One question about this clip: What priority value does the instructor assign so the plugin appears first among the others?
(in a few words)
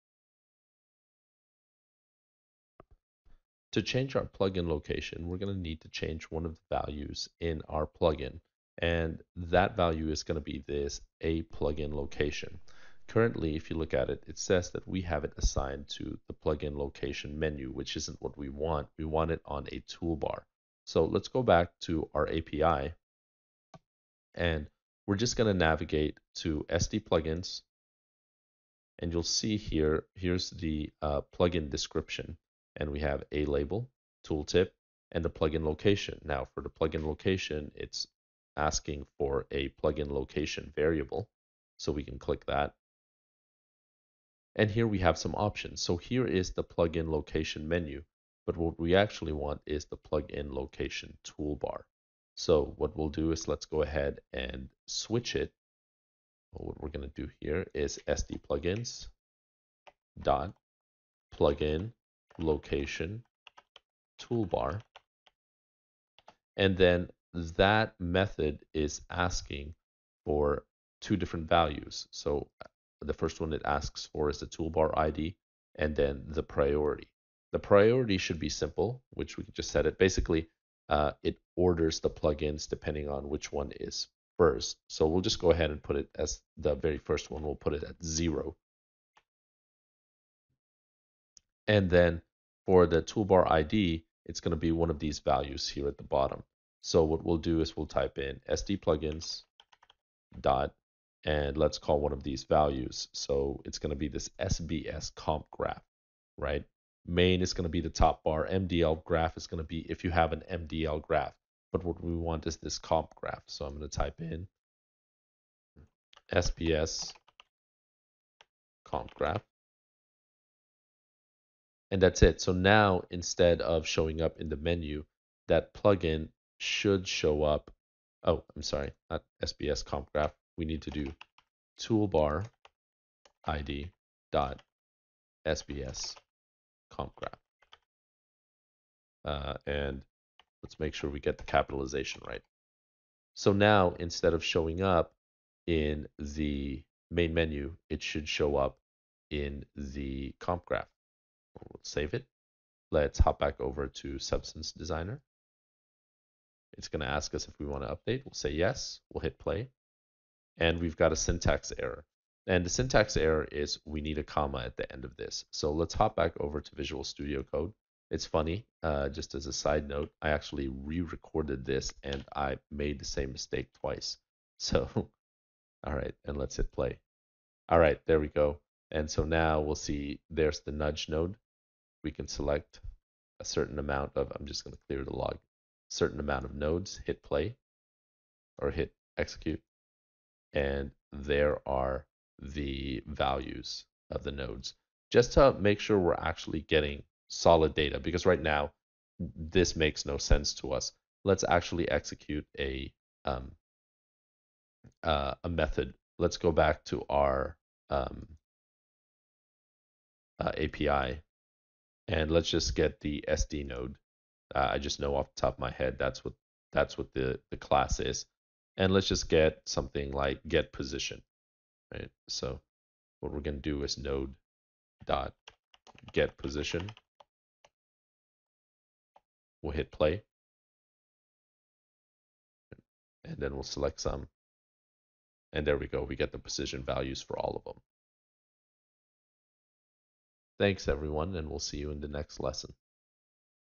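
0.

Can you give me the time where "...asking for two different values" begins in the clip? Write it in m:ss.
1:09.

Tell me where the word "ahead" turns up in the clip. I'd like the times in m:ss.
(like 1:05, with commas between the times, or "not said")
0:53, 1:25.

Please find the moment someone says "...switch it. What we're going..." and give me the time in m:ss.
0:54.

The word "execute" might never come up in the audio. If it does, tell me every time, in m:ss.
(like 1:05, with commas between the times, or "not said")
3:09, 3:21.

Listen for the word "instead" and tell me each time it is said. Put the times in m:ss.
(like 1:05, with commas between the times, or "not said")
2:03, 2:23.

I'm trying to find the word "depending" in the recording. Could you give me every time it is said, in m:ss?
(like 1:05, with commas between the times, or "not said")
1:22.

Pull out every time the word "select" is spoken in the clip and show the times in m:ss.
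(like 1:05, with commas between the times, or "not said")
3:02, 3:53.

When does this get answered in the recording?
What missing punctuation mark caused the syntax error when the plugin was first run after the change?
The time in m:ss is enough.
2:44.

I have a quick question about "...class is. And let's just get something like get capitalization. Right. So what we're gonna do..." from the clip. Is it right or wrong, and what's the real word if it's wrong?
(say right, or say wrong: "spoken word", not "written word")
wrong: "position", not "capitalization".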